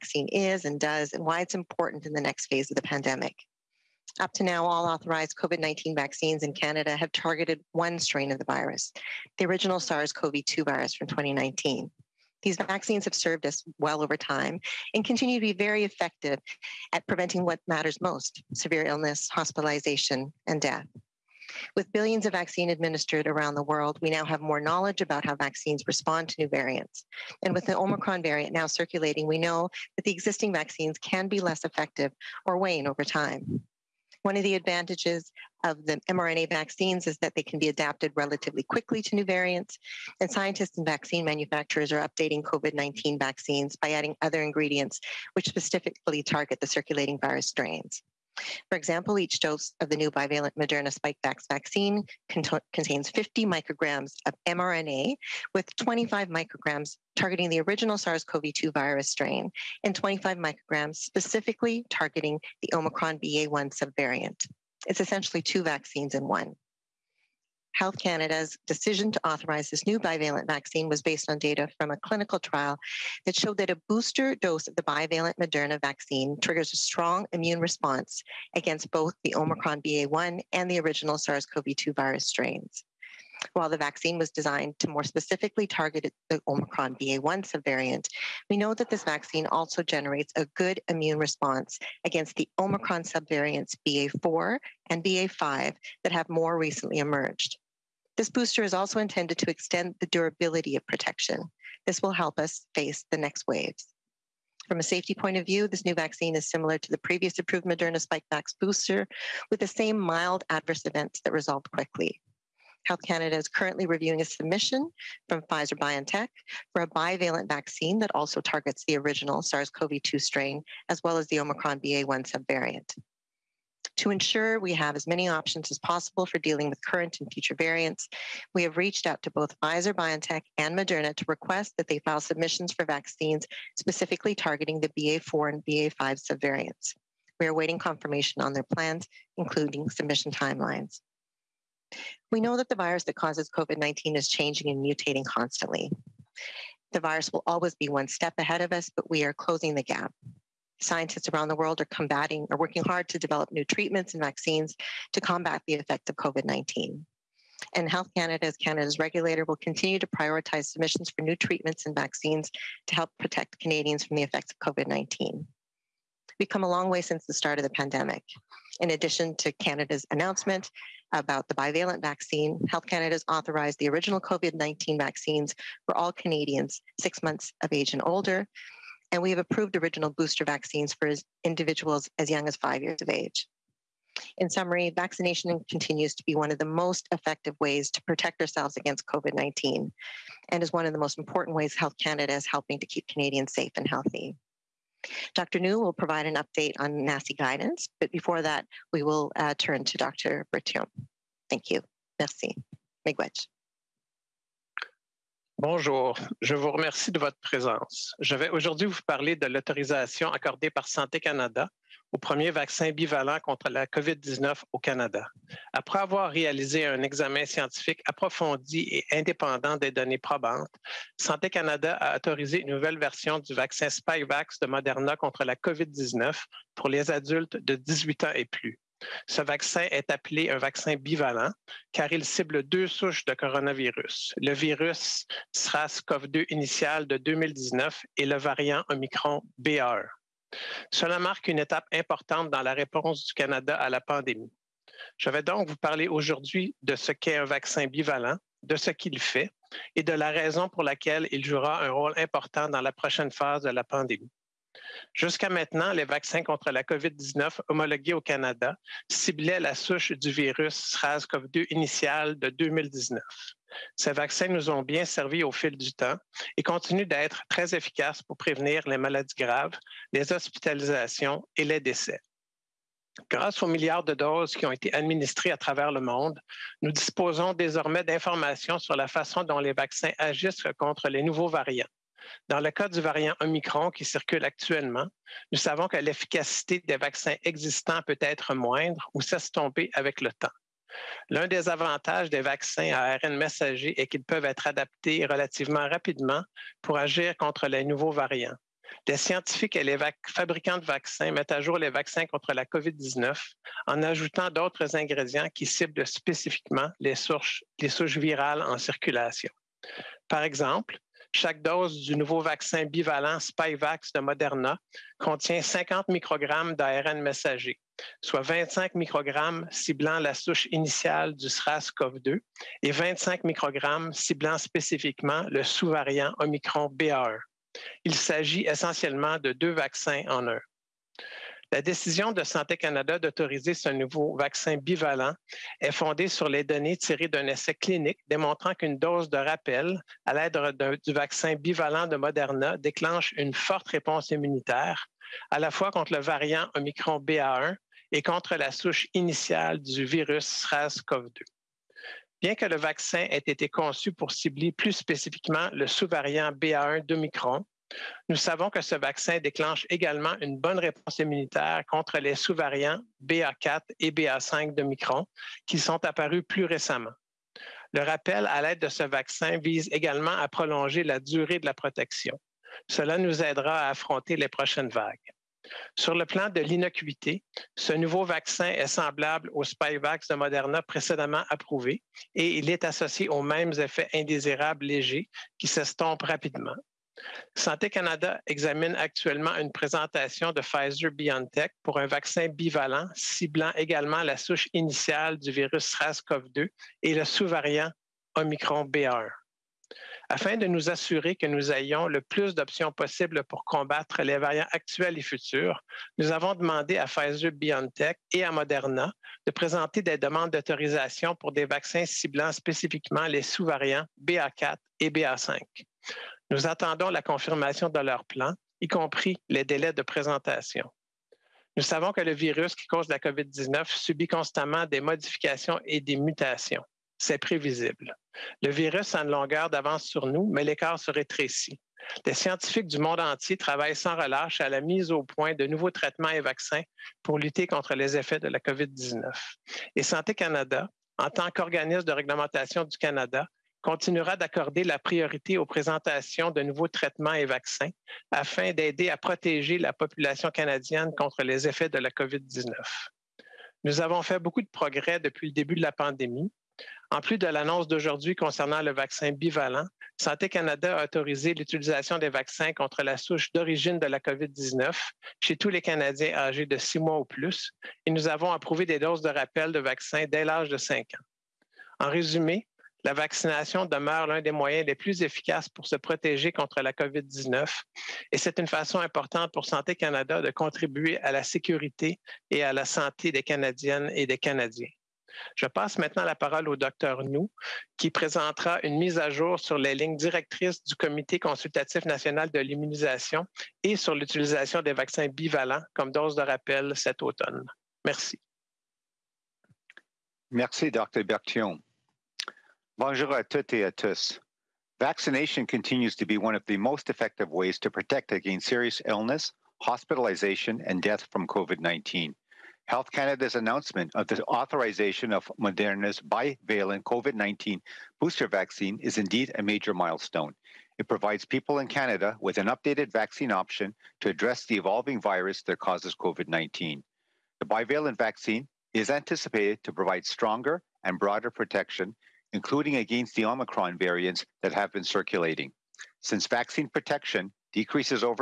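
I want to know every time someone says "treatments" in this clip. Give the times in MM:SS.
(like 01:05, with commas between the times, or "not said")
02:33, 02:41.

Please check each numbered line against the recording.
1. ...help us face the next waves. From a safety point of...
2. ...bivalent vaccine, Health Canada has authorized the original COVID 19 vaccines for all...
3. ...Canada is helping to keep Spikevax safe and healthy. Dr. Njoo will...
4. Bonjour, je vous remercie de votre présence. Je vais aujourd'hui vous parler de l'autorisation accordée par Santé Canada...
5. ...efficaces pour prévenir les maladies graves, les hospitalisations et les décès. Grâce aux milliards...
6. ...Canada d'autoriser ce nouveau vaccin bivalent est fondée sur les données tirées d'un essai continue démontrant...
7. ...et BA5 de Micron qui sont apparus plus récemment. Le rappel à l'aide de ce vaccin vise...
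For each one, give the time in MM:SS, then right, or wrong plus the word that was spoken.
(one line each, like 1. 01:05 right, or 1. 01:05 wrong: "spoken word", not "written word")
1. 01:42 right
2. 02:51 right
3. 03:12 wrong: "Canadians", not "Spikevax"
4. 03:25 right
5. 04:27 right
6. 05:32 wrong: "clinique", not "continue"
7. 06:03 right.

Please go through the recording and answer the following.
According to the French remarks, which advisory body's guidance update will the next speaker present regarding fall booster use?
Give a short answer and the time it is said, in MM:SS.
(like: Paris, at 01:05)
Comité consultatif national de l'immunisation, at 08:10.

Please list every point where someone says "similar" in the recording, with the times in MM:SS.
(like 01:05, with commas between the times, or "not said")
01:46.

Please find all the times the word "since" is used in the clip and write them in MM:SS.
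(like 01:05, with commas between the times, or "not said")
02:47, 08:56.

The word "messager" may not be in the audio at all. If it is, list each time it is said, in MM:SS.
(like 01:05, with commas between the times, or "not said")
04:53, 05:17.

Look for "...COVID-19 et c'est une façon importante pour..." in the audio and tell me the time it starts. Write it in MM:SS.
07:56.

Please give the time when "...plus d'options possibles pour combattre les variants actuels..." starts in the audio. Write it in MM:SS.
06:42.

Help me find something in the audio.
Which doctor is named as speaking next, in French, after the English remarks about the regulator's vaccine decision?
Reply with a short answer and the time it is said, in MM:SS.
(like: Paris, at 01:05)
Dr. Berthiaume, at 03:19.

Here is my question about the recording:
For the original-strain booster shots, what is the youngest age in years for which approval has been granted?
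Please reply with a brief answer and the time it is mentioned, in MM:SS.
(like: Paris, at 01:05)
5, at 03:02.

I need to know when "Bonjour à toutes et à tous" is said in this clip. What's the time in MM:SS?
08:23.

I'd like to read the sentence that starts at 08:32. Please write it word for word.
Health Canada's announcement of the authorization of Moderna's bivalent COVID 19 booster vaccine is indeed a major milestone.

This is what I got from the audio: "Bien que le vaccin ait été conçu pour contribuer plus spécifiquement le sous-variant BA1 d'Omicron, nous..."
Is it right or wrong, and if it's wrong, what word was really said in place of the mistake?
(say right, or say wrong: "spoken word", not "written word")
wrong: "cibler", not "contribuer".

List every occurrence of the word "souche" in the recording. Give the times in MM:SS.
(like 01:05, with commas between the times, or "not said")
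03:52, 04:19, 05:07, 05:20, 05:48, 06:34, 07:43.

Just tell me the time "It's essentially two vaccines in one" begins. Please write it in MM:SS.
01:04.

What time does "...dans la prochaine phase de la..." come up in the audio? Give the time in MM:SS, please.
04:12.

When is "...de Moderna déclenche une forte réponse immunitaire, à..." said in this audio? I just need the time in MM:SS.
05:42.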